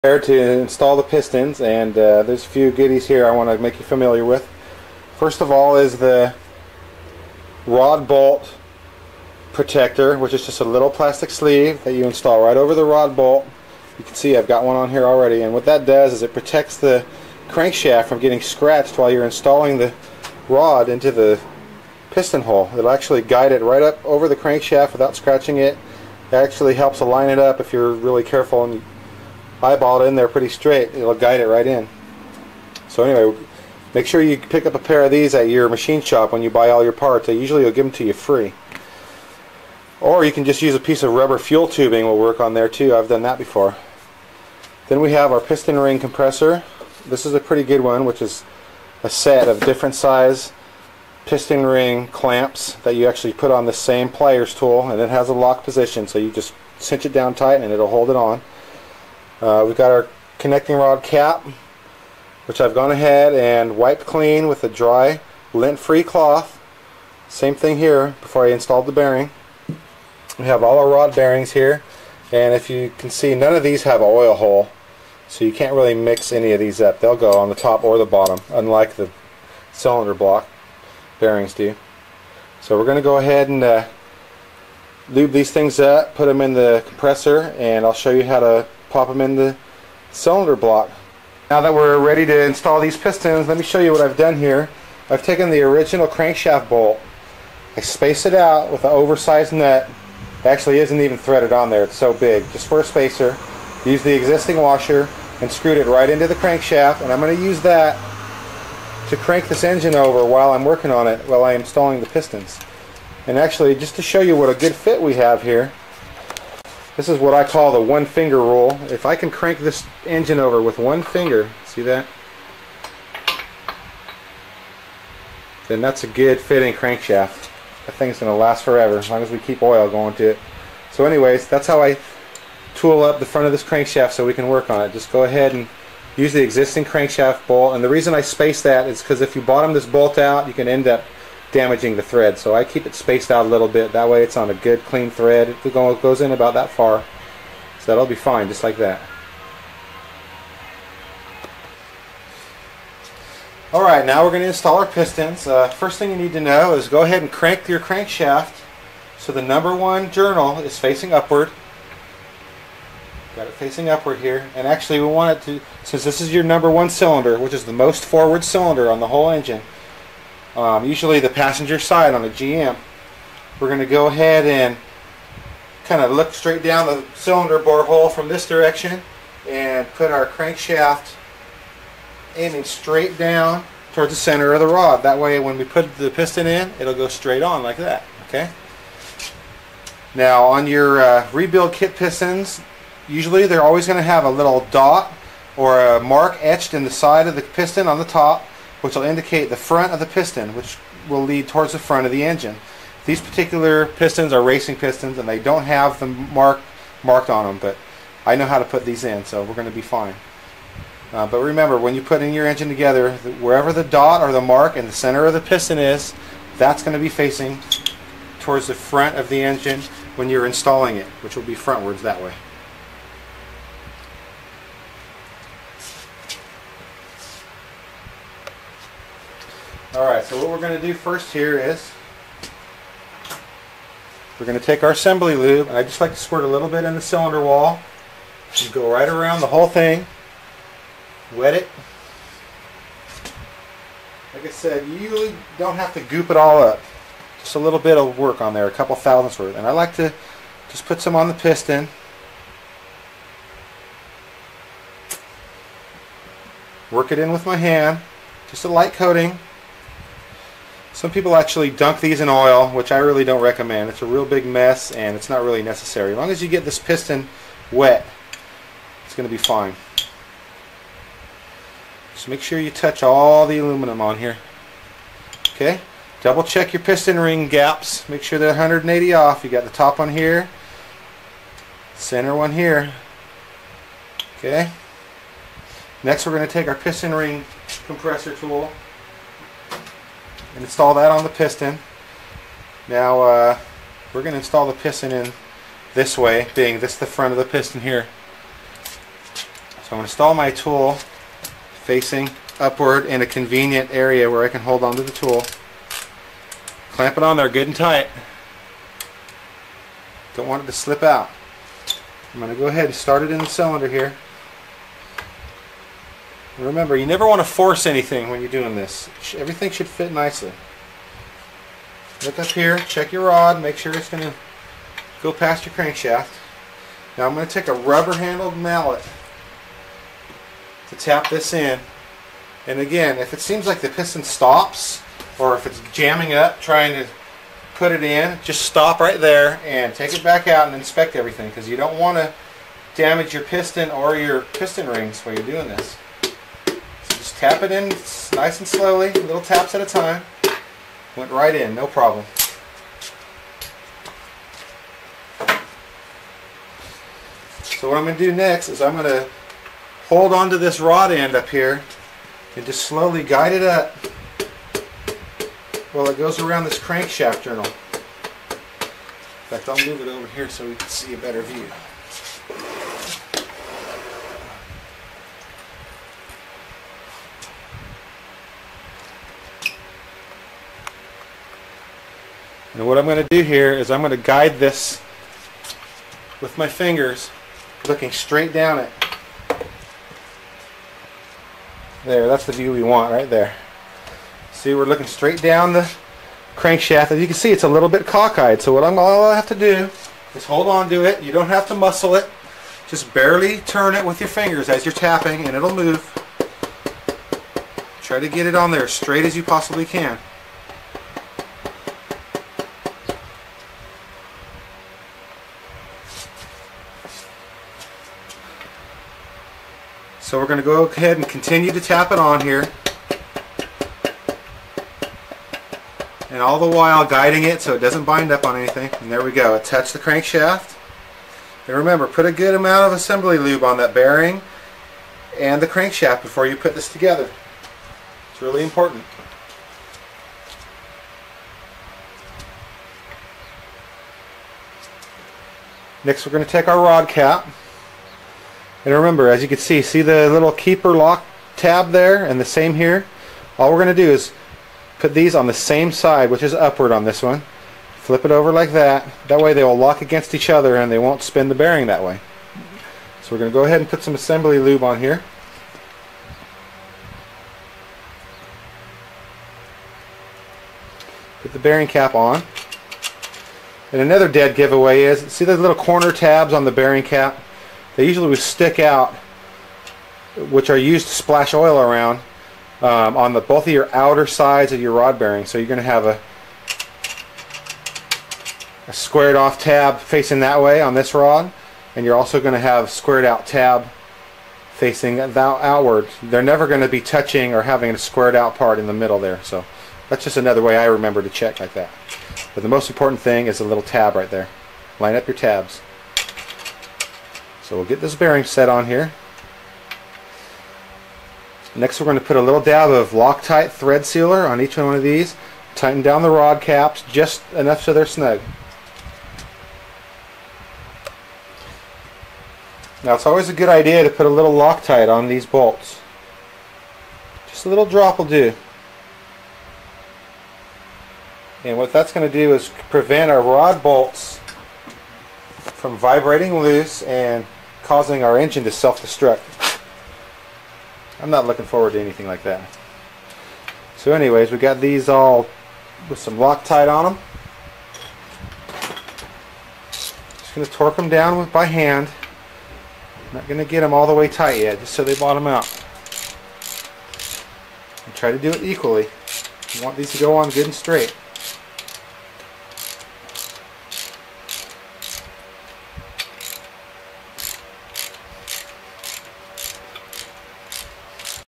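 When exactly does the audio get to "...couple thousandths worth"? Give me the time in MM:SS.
04:08.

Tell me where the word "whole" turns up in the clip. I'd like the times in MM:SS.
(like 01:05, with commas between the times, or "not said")
02:49, 03:59.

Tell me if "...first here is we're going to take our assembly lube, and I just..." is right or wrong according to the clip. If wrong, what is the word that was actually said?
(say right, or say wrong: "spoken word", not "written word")
right.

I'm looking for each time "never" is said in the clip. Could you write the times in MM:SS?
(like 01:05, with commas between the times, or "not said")
05:17, 08:16.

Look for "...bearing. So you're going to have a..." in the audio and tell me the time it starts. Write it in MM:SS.
08:05.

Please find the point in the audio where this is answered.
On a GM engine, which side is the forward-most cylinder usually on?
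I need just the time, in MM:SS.
02:51.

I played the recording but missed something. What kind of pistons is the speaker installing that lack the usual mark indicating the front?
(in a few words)
racing pistons.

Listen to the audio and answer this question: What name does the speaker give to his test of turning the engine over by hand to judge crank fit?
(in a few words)
one finger rule.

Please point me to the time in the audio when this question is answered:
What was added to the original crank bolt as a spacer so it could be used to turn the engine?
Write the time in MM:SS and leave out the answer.
01:38.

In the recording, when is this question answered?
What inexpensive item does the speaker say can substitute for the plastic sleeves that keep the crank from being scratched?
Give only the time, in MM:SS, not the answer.
00:41.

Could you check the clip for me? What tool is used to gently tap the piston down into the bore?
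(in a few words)
rubber-handled mallet.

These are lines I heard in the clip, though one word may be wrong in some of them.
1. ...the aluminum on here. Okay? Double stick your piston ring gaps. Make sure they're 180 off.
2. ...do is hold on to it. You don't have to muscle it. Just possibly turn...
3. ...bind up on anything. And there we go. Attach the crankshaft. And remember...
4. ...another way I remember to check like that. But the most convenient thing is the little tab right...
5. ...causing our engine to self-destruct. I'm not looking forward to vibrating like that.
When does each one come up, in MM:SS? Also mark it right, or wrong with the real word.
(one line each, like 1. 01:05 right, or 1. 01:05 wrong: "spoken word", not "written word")
1. 04:33 wrong: "check", not "stick"
2. 06:39 wrong: "barely", not "possibly"
3. 07:08 right
4. 08:20 wrong: "important", not "convenient"
5. 08:57 wrong: "anything", not "vibrating".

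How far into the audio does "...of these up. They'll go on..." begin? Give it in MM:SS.
01:16.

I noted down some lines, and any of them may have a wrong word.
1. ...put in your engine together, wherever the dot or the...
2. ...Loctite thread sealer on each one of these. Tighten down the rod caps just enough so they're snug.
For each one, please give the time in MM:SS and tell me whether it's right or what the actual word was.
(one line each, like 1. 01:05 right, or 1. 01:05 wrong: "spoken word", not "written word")
1. 03:32 right
2. 08:33 right.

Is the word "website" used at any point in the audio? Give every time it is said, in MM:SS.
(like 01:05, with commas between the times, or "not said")
not said.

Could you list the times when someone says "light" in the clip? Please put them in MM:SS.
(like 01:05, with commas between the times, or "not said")
04:18.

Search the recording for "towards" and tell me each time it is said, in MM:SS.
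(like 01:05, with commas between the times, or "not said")
03:03, 03:21, 03:38.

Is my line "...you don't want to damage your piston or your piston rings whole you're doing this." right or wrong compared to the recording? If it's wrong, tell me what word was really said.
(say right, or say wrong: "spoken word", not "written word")
wrong: "while", not "whole".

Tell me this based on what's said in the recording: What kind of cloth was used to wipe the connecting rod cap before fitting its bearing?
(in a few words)
dry lint-free cloth.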